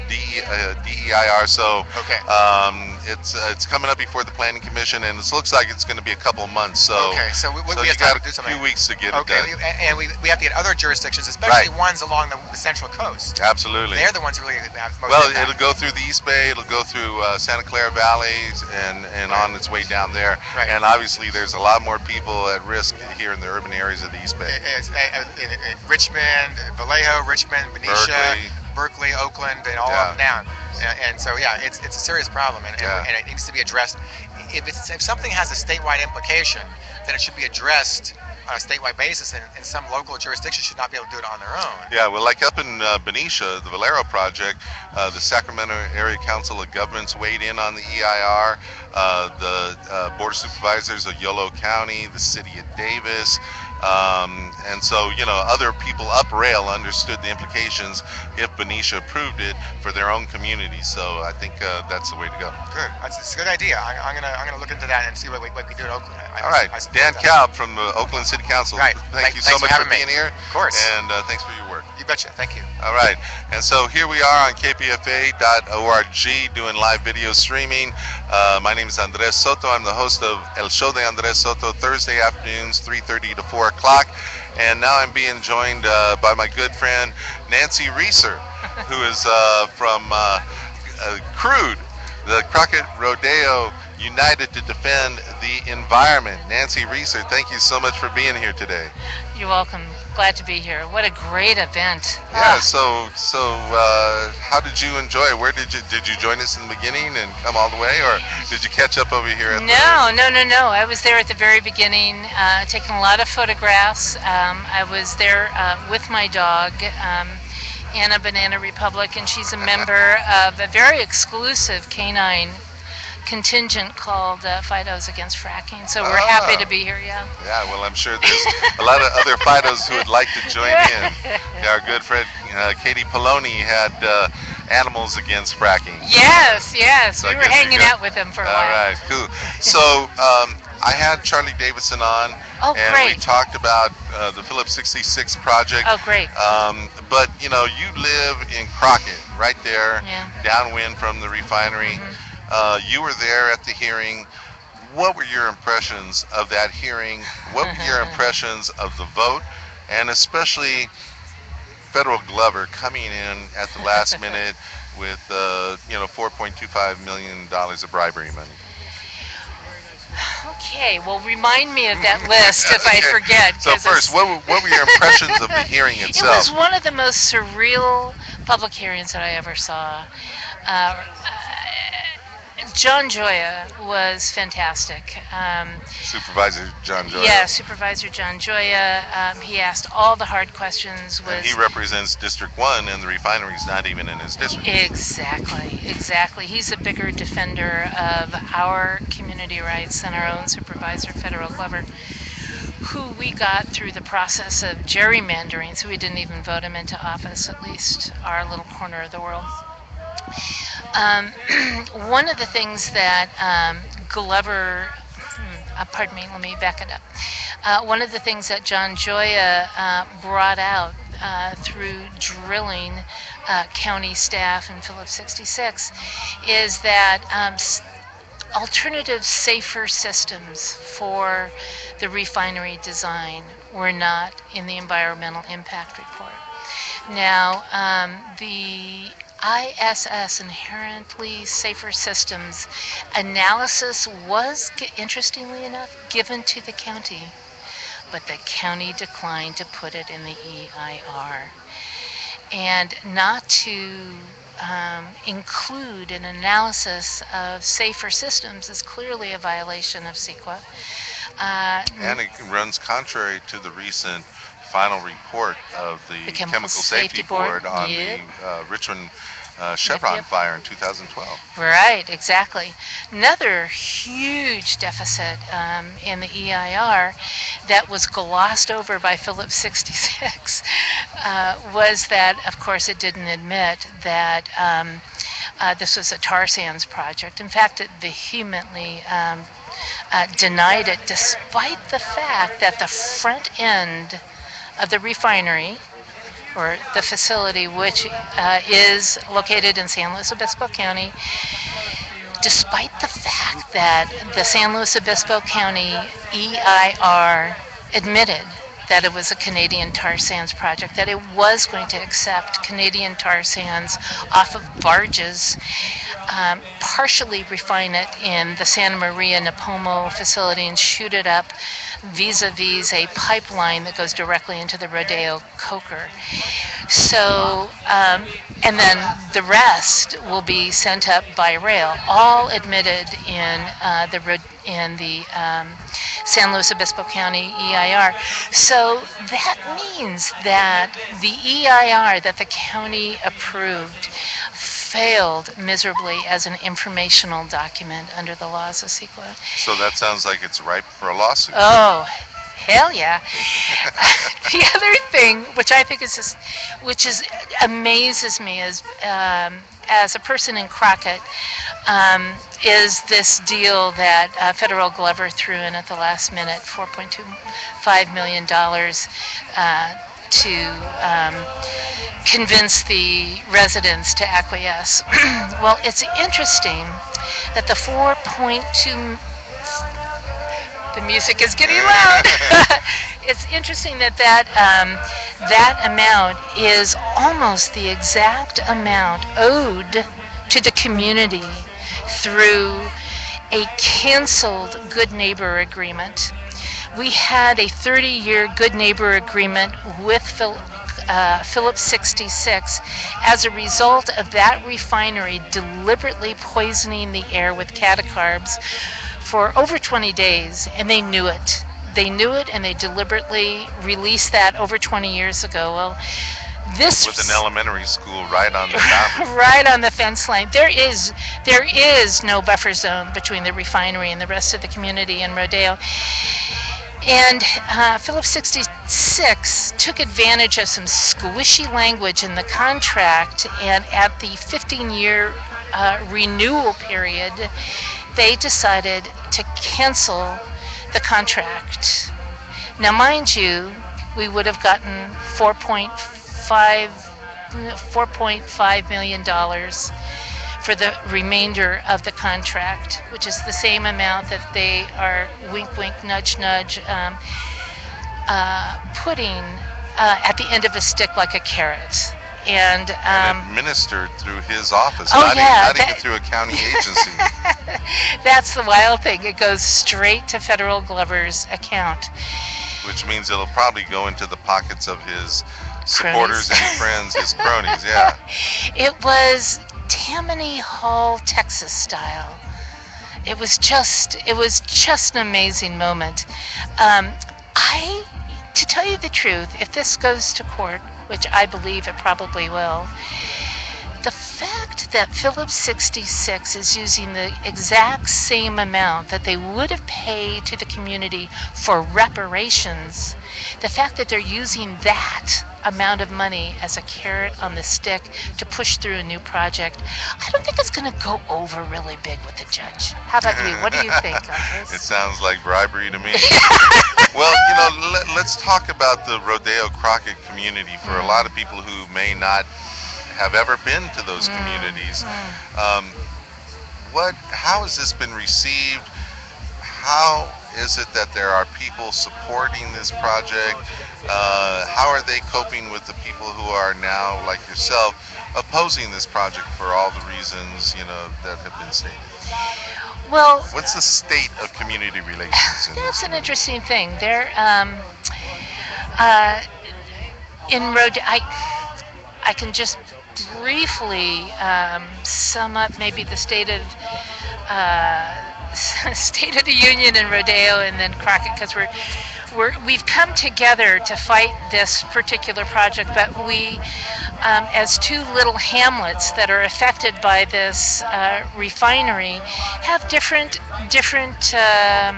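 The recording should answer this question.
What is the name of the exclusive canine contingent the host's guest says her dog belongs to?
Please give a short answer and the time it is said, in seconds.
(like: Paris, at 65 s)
Fidos Against Fracking, at 124 s.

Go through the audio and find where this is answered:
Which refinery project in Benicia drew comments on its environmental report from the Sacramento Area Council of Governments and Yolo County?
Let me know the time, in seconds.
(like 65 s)
43 s.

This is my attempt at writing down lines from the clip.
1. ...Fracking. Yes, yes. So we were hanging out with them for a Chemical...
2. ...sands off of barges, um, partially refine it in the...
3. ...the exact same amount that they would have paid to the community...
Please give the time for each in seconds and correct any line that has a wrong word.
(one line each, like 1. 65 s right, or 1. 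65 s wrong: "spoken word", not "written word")
1. 135 s wrong: "All", not "Chemical"
2. 313 s right
3. 497 s right.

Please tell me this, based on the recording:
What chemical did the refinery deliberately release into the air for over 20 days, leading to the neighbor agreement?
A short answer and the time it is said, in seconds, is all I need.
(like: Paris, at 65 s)
catacarbs, at 407 s.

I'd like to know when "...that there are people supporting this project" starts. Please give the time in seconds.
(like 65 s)
530 s.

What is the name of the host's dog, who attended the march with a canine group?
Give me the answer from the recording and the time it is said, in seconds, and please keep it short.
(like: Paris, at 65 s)
Anna Banana Republic, at 117 s.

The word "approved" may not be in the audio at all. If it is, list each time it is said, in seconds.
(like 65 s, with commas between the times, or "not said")
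59 s, 343 s.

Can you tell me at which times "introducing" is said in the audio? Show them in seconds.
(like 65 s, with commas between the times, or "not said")
not said.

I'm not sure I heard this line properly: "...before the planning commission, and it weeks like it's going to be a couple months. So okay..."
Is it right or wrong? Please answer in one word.
wrong.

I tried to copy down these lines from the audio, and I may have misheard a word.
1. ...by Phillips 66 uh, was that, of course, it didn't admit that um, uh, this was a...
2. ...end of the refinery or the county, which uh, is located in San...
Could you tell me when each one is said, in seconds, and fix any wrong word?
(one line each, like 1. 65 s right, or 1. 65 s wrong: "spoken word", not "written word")
1. 278 s right
2. 293 s wrong: "facility", not "county".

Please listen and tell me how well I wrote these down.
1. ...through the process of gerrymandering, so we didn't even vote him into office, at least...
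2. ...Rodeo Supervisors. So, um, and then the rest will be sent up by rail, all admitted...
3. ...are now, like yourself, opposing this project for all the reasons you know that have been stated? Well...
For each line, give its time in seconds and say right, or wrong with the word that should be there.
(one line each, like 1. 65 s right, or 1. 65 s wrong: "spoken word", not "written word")
1. 203 s right
2. 324 s wrong: "Coker", not "Supervisors"
3. 536 s right.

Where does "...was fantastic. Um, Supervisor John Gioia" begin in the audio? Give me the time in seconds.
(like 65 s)
183 s.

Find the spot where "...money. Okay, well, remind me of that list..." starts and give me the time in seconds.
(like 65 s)
168 s.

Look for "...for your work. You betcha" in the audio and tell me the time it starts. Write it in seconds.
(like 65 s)
71 s.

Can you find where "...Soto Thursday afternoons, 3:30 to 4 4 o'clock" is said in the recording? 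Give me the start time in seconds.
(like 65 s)
81 s.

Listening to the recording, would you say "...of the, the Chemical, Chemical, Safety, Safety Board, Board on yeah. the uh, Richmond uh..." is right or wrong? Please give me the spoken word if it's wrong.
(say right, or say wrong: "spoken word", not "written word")
right.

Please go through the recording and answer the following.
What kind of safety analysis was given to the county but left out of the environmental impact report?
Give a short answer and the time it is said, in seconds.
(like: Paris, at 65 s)
Inherently Safer Systems, at 240 s.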